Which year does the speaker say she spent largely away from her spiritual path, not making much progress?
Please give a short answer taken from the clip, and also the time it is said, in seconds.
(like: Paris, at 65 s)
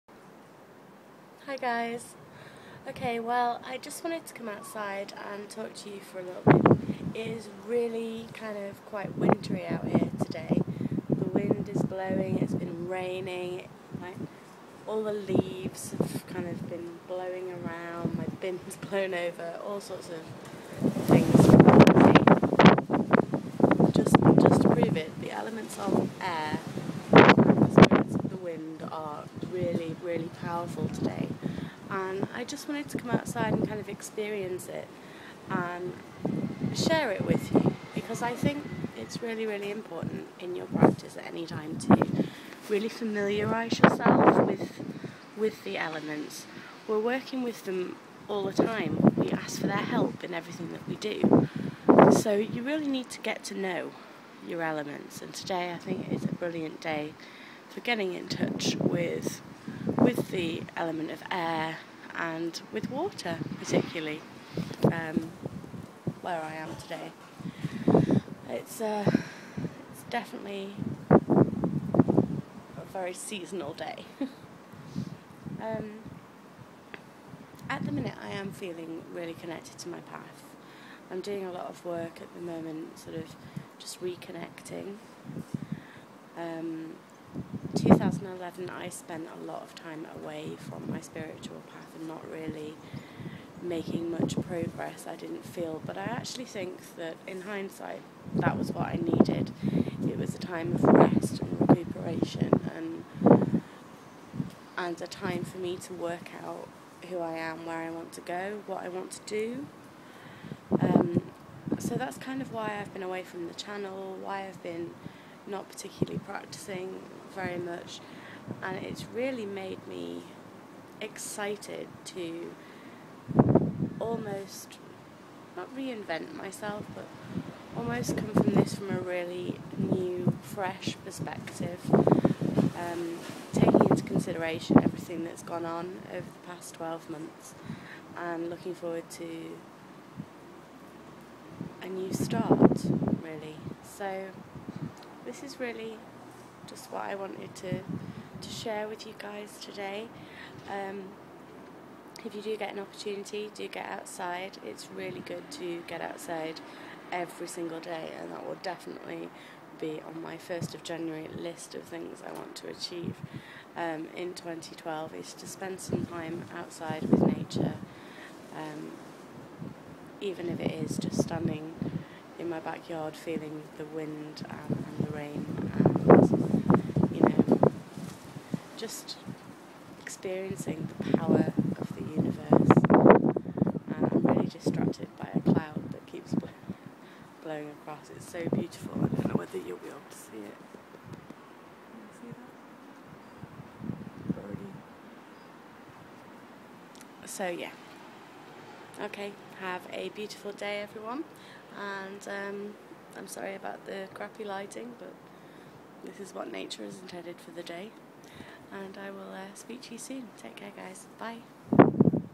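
2011, at 87 s.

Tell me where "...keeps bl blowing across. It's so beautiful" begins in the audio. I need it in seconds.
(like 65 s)
186 s.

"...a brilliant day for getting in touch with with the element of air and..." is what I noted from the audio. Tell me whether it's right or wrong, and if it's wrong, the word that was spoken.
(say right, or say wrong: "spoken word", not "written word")
right.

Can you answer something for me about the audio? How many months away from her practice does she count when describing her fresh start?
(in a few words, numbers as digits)
12.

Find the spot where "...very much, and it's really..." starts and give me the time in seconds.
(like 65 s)
117 s.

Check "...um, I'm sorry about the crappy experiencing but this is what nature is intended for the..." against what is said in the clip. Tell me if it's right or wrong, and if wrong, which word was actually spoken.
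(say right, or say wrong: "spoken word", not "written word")
wrong: "lighting", not "experiencing".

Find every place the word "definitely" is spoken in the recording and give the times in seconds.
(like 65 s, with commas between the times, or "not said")
70 s, 158 s.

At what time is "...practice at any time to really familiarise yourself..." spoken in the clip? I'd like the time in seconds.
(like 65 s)
40 s.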